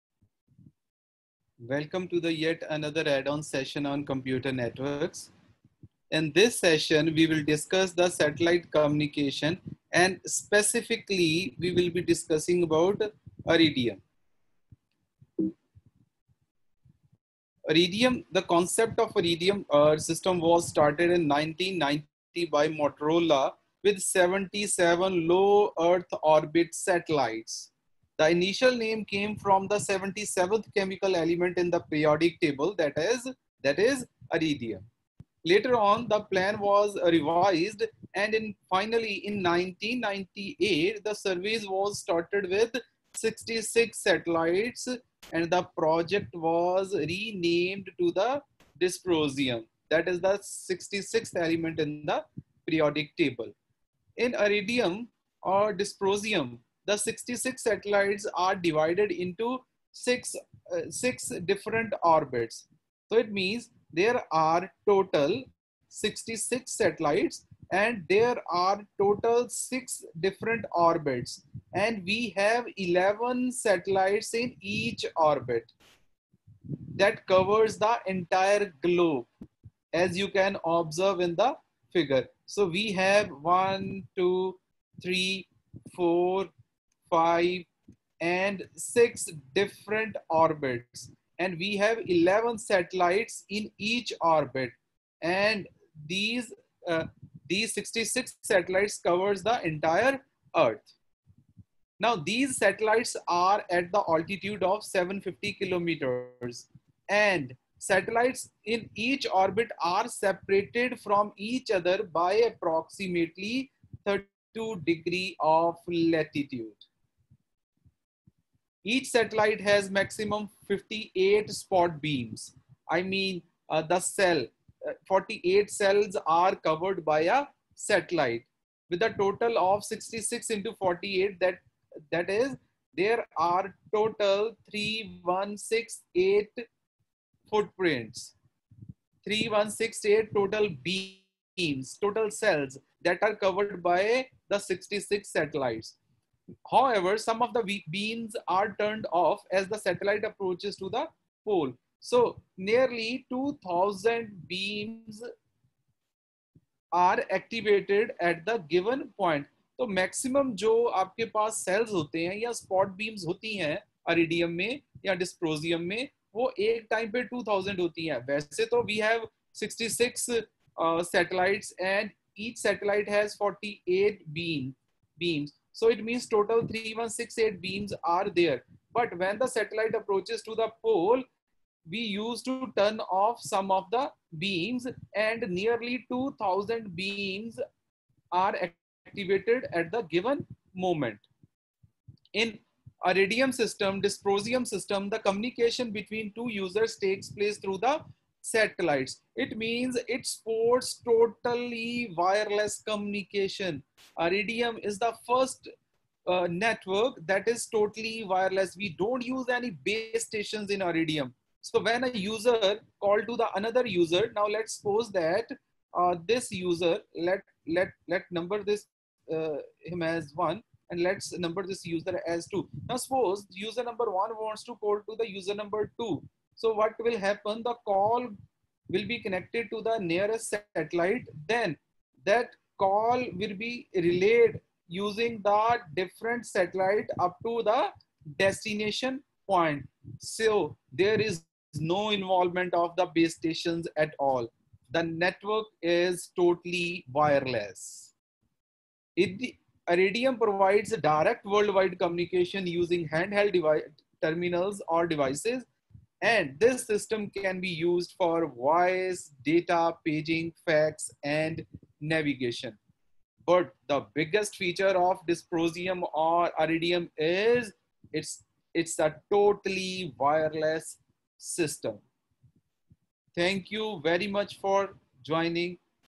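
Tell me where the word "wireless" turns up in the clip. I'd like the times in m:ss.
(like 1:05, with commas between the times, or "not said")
3:22, 3:28, 4:07, 4:30.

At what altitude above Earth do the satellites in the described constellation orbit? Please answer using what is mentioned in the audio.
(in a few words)
750 kilometers.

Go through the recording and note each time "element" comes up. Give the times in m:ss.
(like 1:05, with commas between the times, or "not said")
0:31, 0:51.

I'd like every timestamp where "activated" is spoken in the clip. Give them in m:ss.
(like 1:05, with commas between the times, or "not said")
2:37, 3:09.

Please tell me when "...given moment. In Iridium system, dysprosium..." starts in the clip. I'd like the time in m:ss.
3:10.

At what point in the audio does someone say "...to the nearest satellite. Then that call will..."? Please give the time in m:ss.
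3:49.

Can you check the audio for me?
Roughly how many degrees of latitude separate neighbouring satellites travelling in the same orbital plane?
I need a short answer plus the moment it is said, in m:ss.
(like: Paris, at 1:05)
32 degrees, at 1:54.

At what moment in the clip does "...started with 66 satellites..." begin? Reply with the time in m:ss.
0:41.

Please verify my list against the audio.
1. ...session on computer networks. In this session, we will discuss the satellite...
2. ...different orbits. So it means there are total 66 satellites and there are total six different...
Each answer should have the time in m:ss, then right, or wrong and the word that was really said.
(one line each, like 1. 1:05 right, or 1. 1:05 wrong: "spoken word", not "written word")
1. 0:03 right
2. 1:01 right.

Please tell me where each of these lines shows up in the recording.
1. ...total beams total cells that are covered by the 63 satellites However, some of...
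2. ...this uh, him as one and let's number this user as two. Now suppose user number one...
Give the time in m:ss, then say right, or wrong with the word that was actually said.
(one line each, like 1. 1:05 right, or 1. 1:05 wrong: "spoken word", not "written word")
1. 2:20 wrong: "66", not "63"
2. 3:38 right.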